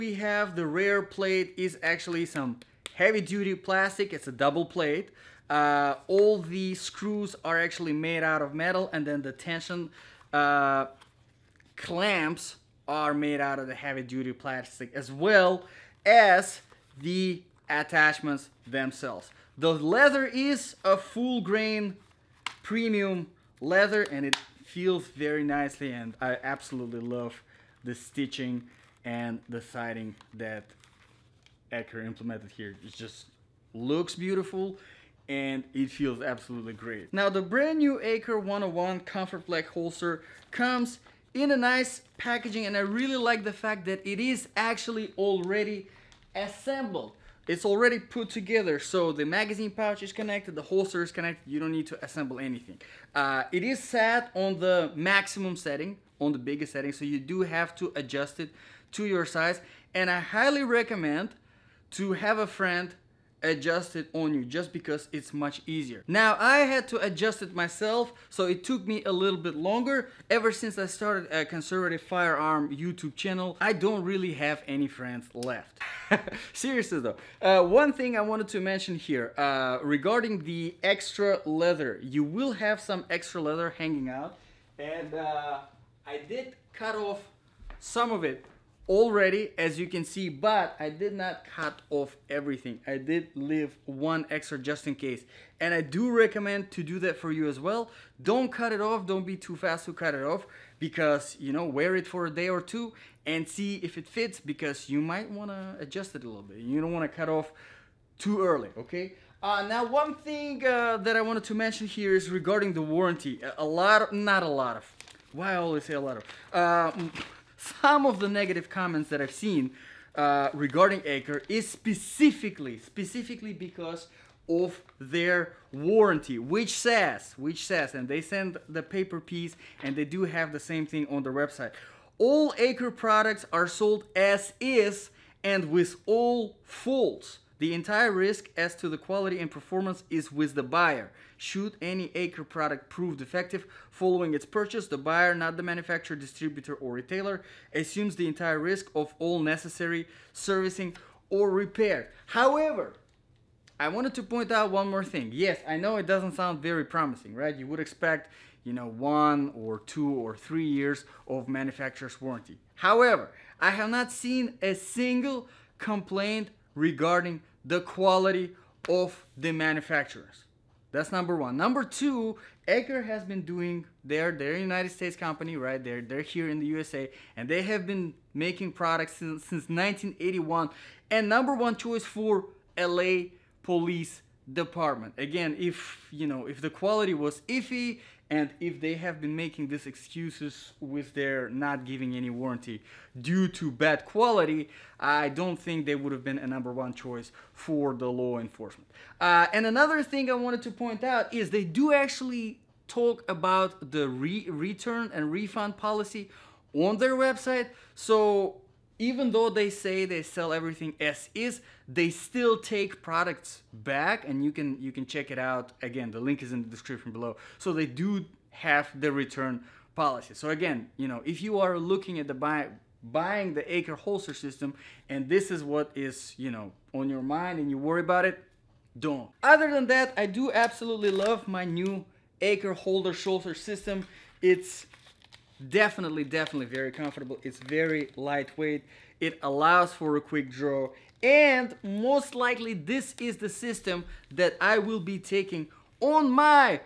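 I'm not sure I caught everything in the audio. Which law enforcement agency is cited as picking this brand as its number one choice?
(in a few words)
LA police department.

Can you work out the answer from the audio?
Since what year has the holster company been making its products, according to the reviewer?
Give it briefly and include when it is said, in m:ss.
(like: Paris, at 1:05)
1981, at 2:59.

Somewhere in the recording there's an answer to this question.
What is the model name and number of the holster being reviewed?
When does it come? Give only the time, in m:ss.
0:38.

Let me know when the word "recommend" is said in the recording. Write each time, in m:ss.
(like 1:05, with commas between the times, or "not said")
1:00, 1:36.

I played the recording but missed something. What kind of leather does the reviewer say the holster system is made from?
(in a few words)
full grain premium leather.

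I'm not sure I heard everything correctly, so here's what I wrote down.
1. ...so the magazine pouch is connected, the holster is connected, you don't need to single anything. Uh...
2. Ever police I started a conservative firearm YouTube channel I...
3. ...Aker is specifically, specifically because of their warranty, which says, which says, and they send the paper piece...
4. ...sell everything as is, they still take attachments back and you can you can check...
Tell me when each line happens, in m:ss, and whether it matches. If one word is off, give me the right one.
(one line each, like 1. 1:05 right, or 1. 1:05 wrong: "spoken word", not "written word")
1. 0:48 wrong: "assemble", not "single"
2. 1:10 wrong: "since", not "police"
3. 2:01 right
4. 3:30 wrong: "products", not "attachments".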